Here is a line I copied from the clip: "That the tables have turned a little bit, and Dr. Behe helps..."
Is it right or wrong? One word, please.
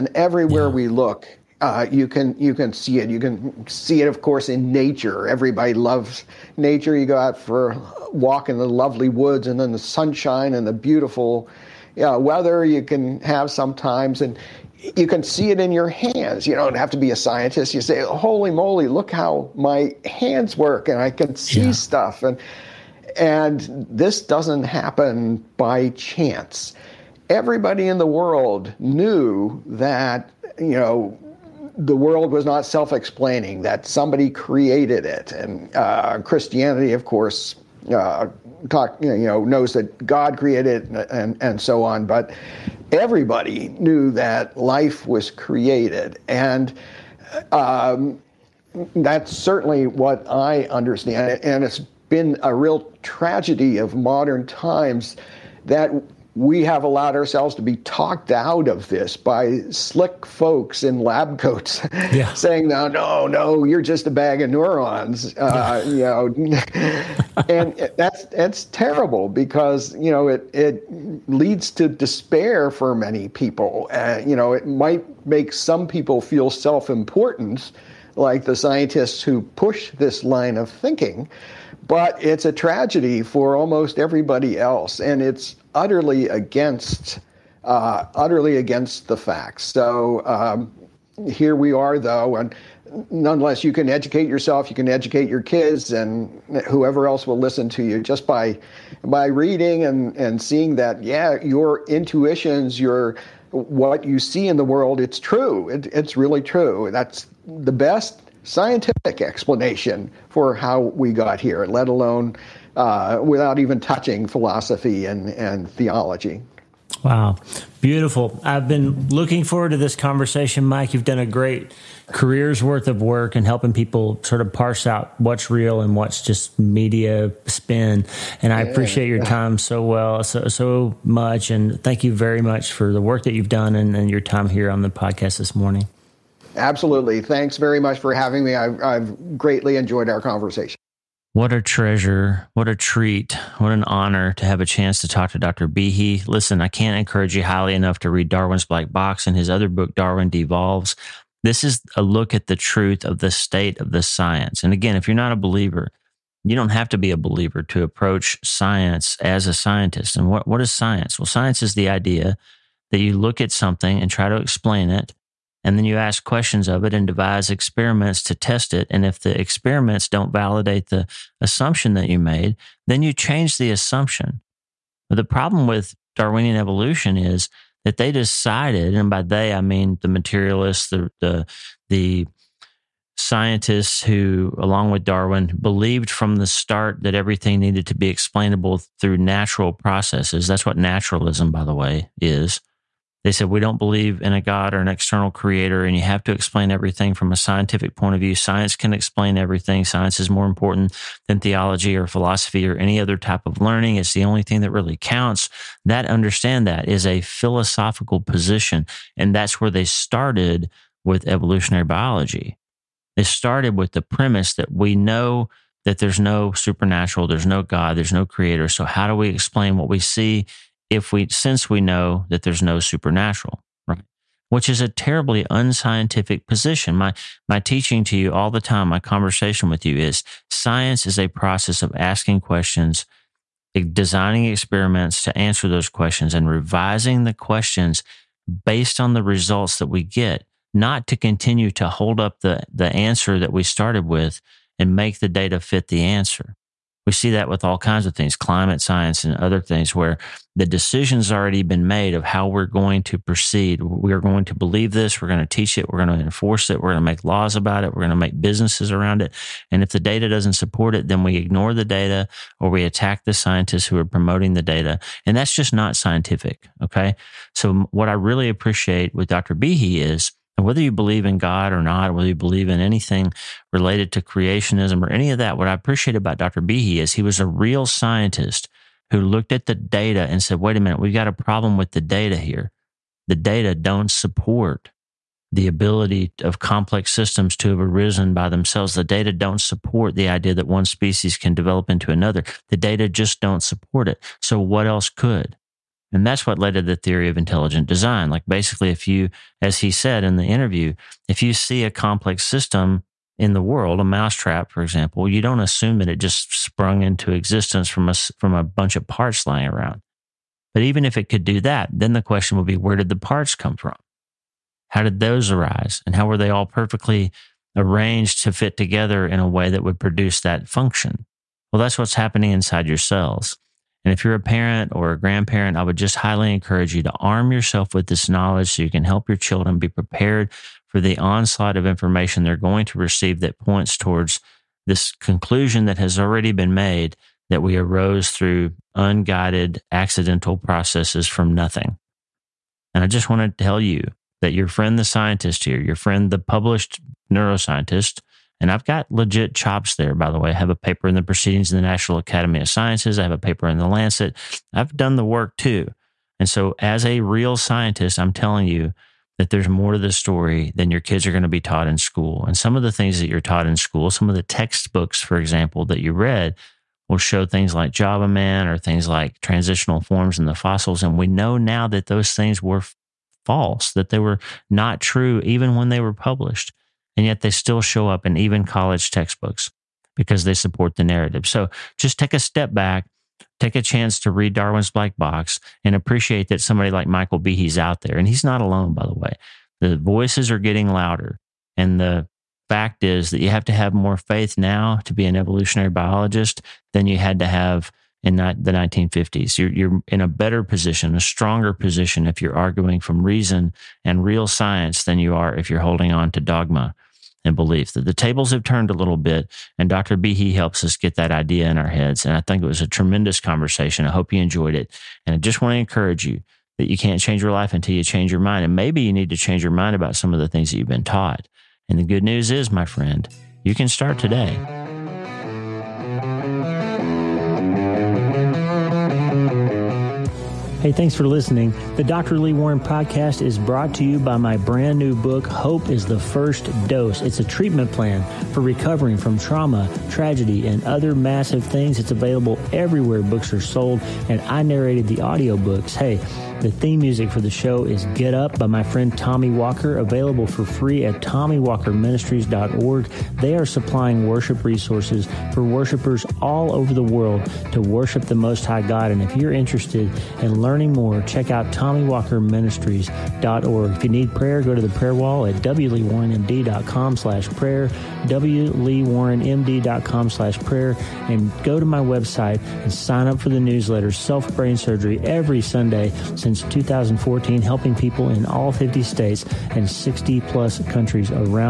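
right.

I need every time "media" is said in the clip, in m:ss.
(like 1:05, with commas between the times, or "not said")
2:06.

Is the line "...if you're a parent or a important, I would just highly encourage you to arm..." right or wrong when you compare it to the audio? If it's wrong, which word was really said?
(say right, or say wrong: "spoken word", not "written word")
wrong: "grandparent", not "important".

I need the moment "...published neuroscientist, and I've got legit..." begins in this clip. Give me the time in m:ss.
5:46.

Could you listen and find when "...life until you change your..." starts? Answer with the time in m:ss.
6:57.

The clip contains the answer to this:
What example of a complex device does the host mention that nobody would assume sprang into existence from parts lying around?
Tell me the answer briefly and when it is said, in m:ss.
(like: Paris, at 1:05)
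a mousetrap, at 5:03.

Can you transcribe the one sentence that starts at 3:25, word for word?
That, understand that, is a philosophical position.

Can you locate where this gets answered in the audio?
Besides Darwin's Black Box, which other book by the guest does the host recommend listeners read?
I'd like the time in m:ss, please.
2:29.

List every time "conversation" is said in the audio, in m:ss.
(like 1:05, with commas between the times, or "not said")
1:59, 2:20, 3:48, 6:53.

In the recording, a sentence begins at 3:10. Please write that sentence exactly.
That's what naturalism, by the way, is.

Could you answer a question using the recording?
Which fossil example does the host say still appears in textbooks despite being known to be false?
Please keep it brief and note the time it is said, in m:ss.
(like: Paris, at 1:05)
Java Man, at 6:07.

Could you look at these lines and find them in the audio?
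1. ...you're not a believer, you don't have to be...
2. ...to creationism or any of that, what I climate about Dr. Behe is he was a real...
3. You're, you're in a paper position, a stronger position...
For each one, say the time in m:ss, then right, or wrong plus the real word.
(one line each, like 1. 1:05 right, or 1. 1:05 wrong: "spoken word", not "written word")
1. 2:35 right
2. 4:34 wrong: "appreciate", not "climate"
3. 6:39 wrong: "better", not "paper".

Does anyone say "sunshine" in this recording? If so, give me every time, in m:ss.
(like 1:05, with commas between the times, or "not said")
0:09.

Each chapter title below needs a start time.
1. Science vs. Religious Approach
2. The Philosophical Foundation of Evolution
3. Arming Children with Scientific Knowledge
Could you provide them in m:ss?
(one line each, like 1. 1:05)
1. 1:56
2. 3:32
3. 5:22.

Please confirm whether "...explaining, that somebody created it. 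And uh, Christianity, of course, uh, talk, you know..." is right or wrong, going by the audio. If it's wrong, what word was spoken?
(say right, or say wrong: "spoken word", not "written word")
right.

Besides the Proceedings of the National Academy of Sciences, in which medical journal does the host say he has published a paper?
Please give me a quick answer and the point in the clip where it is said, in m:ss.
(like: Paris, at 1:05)
The Lancet, at 5:53.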